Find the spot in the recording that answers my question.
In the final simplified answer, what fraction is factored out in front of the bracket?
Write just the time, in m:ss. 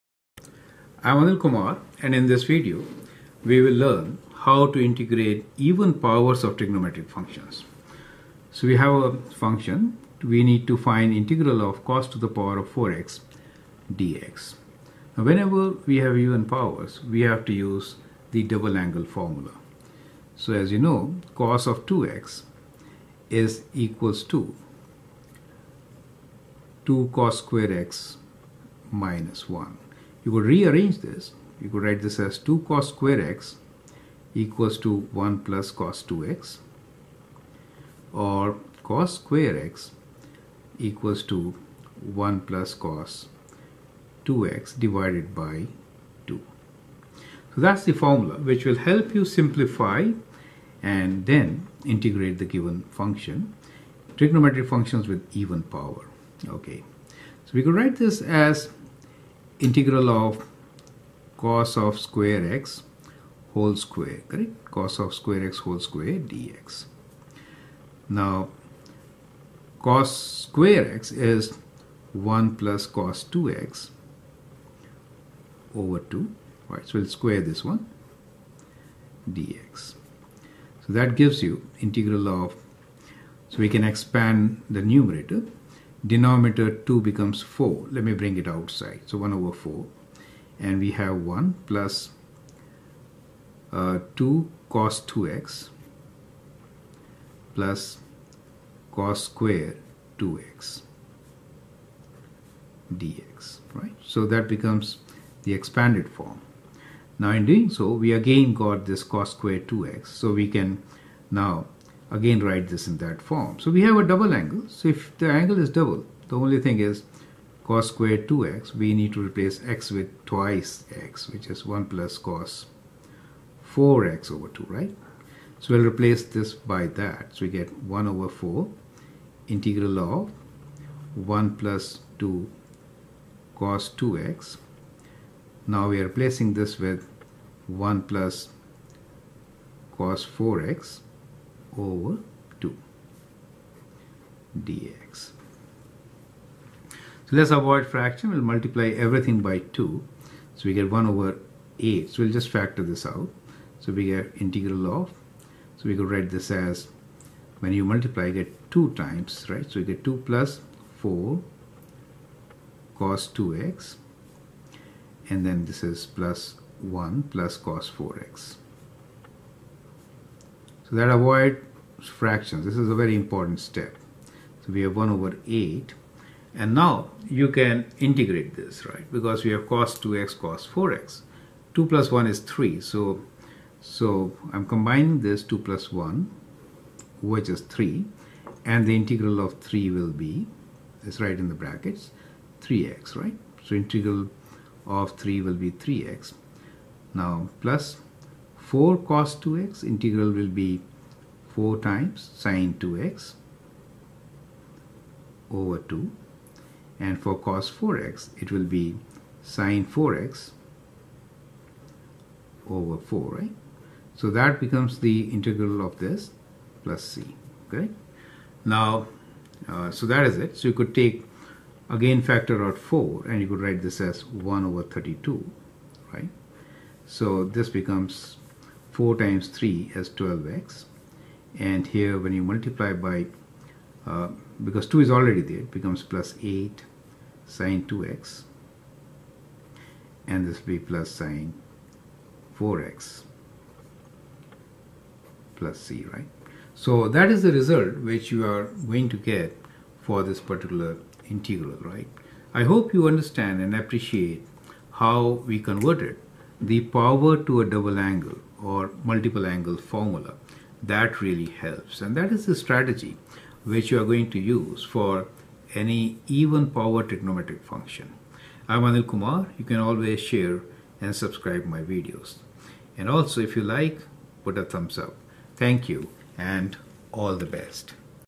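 3:44.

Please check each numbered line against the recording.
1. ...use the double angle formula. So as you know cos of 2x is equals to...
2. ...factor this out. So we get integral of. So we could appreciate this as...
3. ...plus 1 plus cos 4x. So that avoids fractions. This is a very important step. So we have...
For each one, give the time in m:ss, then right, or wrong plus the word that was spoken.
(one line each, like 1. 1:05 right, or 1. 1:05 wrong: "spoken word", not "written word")
1. 0:17 right
2. 2:32 wrong: "write", not "appreciate"
3. 2:46 right.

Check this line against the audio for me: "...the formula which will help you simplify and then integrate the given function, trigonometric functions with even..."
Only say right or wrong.
right.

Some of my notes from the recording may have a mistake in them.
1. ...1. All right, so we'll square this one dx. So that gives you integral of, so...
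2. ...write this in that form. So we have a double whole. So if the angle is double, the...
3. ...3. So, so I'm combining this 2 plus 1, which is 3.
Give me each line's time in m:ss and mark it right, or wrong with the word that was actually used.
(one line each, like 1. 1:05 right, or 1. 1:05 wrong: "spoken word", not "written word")
1. 1:15 wrong: "2", not "1"
2. 1:52 wrong: "angle", not "whole"
3. 3:02 right.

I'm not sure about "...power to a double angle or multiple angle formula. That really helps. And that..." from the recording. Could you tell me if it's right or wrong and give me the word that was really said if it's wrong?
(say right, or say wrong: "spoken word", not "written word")
right.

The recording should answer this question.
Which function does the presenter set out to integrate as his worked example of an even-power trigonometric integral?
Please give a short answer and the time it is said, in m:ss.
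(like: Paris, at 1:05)
cos^4 x, at 0:11.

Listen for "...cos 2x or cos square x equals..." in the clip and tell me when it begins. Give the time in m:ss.
0:35.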